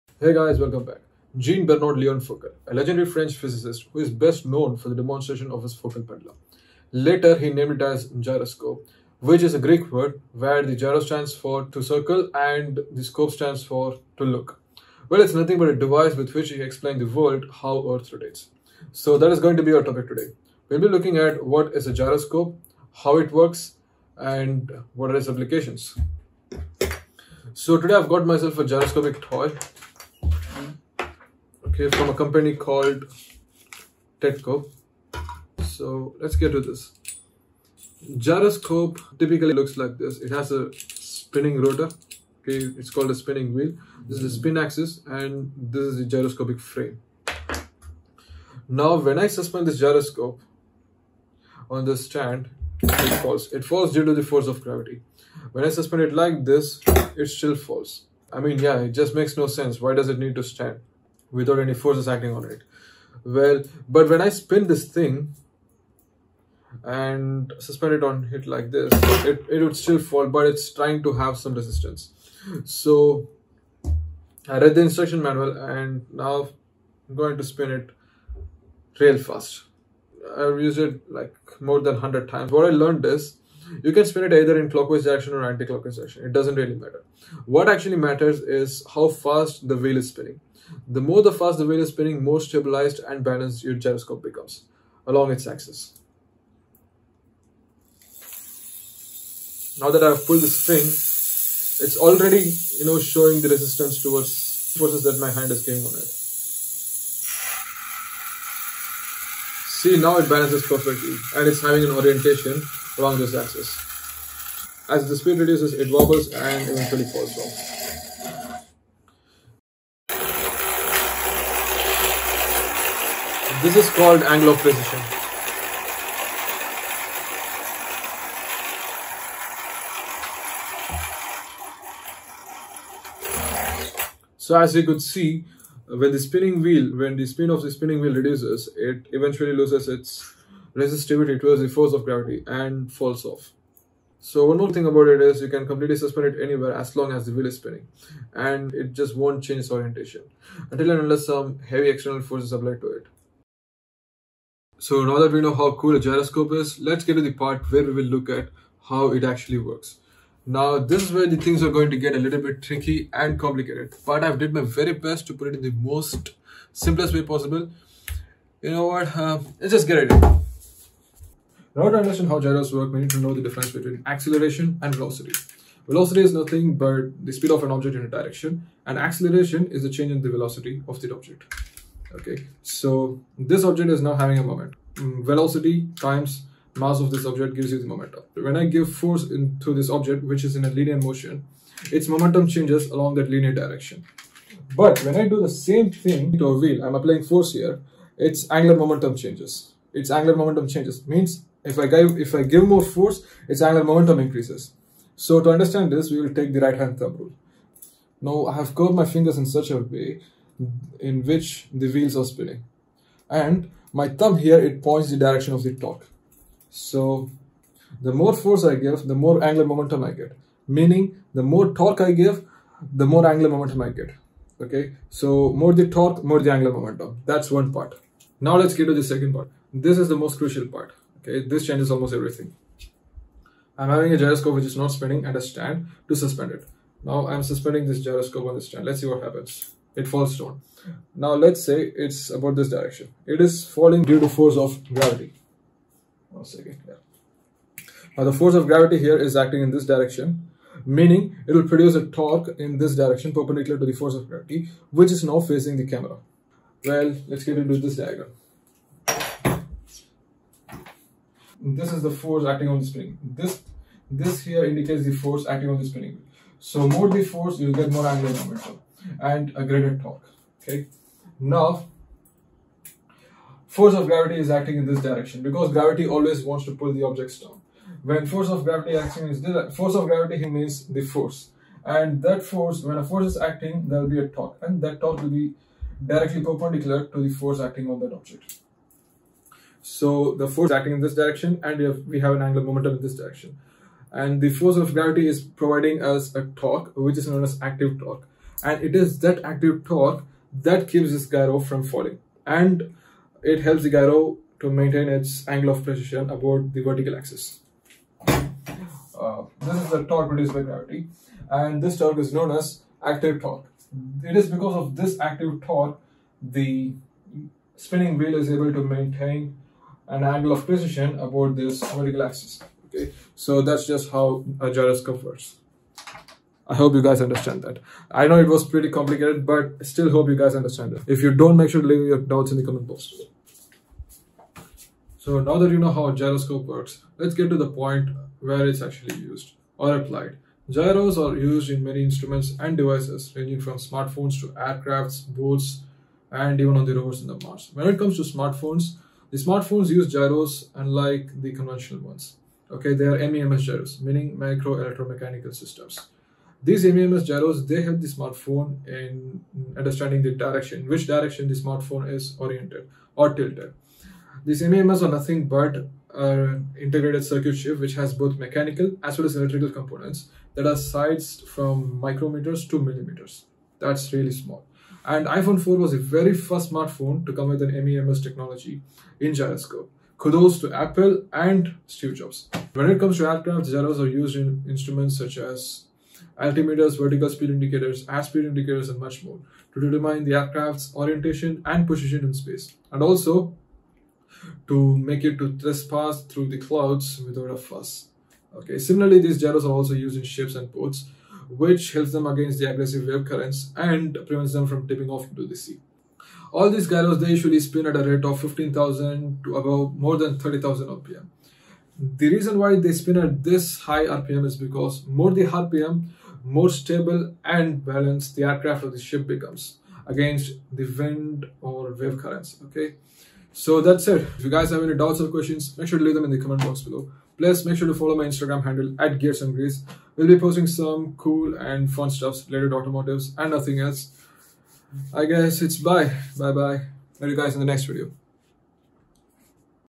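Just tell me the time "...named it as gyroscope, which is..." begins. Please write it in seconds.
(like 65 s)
7 s.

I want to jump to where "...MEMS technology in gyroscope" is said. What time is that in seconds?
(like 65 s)
377 s.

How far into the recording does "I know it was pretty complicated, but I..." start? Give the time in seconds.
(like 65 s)
328 s.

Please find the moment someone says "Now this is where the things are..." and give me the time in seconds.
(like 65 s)
160 s.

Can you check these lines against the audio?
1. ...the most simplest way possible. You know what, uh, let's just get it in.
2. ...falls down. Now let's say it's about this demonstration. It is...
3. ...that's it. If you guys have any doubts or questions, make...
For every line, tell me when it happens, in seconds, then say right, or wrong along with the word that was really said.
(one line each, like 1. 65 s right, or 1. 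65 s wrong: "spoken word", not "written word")
1. 165 s right
2. 240 s wrong: "direction", not "demonstration"
3. 423 s right.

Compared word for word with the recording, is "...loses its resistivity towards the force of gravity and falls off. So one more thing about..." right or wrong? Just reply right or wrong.
right.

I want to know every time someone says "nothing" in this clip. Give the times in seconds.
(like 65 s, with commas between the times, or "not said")
15 s, 176 s, 365 s, 433 s.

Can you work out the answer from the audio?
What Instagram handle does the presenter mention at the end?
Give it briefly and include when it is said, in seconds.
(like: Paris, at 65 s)
Gears and Grease, at 429 s.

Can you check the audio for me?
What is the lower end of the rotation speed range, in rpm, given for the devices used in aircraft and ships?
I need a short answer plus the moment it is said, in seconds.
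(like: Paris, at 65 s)
15,000, at 408 s.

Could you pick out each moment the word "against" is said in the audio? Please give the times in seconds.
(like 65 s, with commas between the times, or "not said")
402 s, 420 s.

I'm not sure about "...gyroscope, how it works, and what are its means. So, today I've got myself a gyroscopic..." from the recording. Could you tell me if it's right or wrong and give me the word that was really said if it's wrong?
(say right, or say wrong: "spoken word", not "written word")
wrong: "applications", not "means".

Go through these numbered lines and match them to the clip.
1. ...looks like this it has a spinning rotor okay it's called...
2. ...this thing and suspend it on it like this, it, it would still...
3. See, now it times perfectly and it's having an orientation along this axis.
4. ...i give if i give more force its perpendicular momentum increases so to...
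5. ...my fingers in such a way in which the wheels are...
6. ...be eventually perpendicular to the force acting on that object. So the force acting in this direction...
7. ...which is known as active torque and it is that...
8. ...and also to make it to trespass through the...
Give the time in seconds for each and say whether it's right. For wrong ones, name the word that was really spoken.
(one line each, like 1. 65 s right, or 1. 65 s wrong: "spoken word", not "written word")
1. 39 s right
2. 64 s right
3. 109 s wrong: "balances", not "times"
4. 201 s wrong: "angular", not "perpendicular"
5. 209 s right
6. 285 s wrong: "directly", not "eventually"
7. 296 s right
8. 392 s right.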